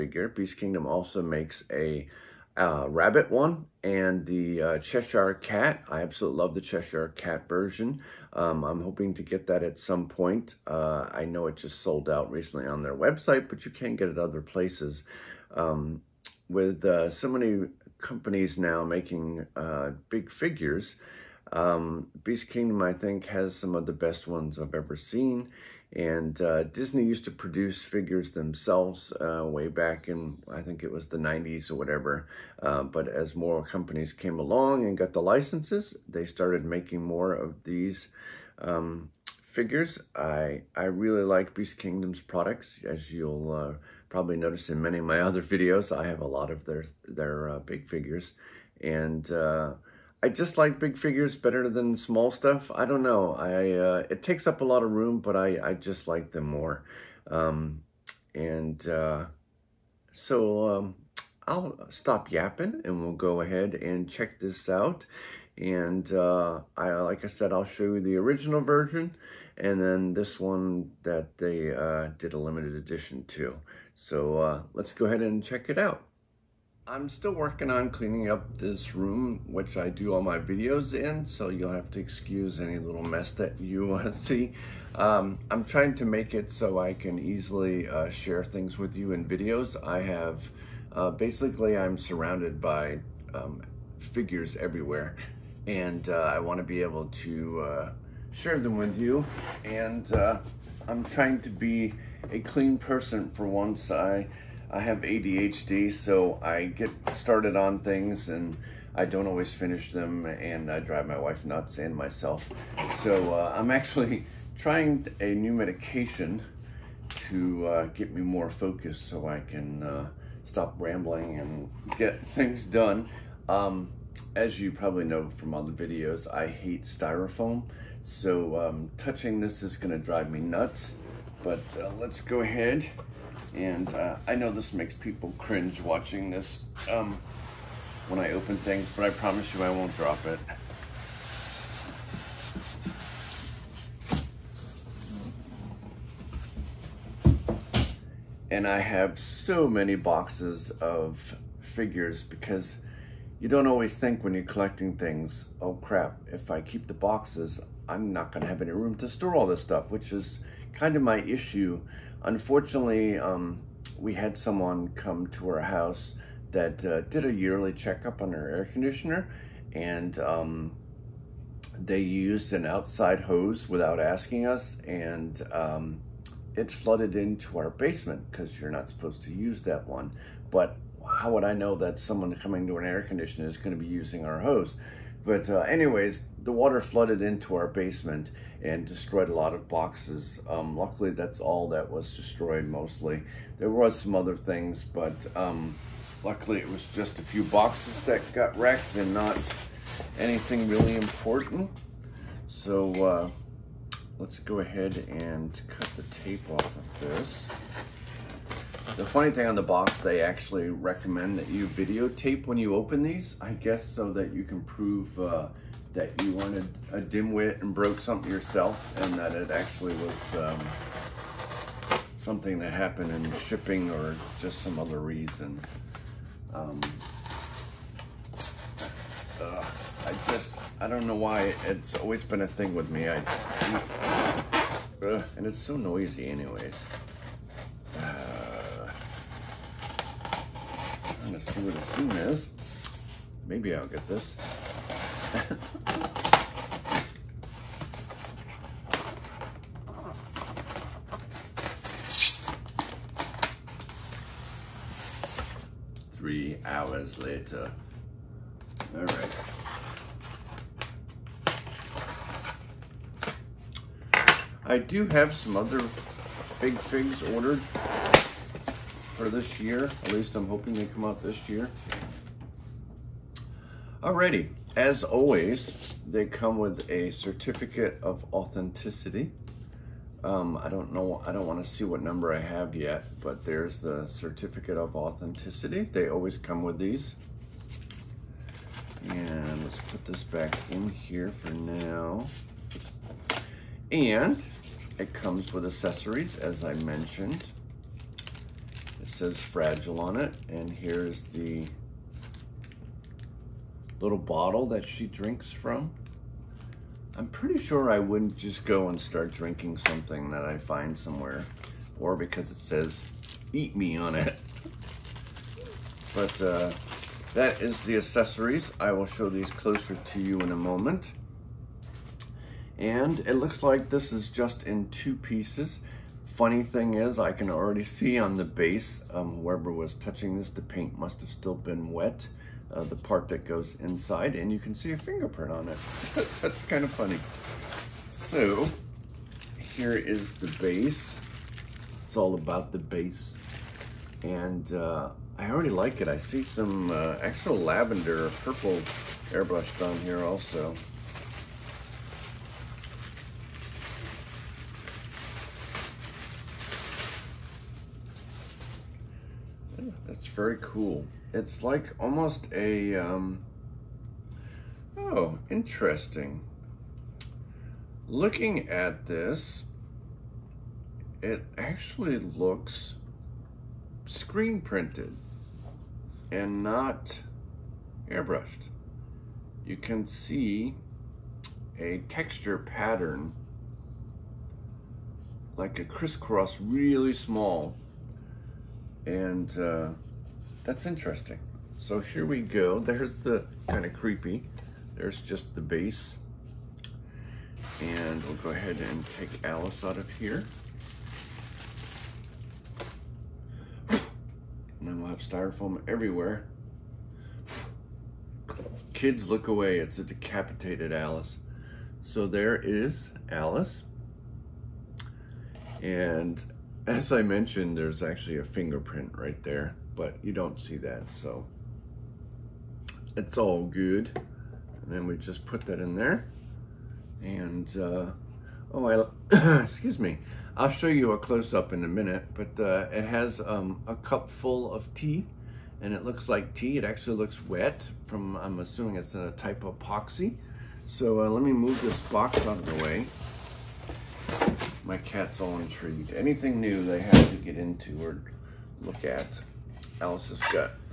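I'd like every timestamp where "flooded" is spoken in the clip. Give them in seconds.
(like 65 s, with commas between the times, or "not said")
176 s, 186 s.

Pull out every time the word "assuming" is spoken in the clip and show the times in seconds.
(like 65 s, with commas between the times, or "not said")
438 s.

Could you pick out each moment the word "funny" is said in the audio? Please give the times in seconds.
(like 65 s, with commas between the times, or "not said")
209 s, 326 s, 336 s.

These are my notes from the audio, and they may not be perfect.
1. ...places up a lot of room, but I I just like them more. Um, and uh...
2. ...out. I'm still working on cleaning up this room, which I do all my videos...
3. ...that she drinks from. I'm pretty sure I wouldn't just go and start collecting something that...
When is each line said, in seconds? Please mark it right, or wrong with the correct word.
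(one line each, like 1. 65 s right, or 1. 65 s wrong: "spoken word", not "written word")
1. 54 s wrong: "takes", not "places"
2. 75 s right
3. 304 s wrong: "drinking", not "collecting".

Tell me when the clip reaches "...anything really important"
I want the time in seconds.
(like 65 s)
200 s.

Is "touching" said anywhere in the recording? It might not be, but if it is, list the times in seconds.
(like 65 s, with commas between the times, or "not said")
128 s, 329 s.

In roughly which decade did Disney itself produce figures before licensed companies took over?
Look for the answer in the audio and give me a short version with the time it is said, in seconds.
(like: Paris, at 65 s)
the 90s, at 31 s.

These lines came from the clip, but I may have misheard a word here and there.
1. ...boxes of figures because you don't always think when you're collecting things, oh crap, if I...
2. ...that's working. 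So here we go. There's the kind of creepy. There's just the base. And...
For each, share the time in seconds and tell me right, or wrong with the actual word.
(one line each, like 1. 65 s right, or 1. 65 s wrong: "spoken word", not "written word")
1. 149 s right
2. 390 s wrong: "interesting", not "working".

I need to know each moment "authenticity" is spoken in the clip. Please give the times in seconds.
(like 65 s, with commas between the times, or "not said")
278 s, 284 s.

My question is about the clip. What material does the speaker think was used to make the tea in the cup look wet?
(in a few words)
epoxy.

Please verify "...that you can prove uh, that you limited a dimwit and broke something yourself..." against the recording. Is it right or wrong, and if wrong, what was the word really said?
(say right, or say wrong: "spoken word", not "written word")
wrong: "wanted", not "limited".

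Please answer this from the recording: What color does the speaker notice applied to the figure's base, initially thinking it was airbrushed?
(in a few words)
lavender purple.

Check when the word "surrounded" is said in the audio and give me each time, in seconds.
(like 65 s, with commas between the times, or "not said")
91 s.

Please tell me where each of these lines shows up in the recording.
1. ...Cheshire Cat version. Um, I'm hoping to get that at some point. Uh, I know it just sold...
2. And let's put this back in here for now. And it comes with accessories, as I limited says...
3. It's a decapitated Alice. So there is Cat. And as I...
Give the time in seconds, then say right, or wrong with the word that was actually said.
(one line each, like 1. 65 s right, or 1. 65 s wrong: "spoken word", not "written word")
1. 6 s right
2. 289 s wrong: "mentioned", not "limited"
3. 409 s wrong: "Alice", not "Cat".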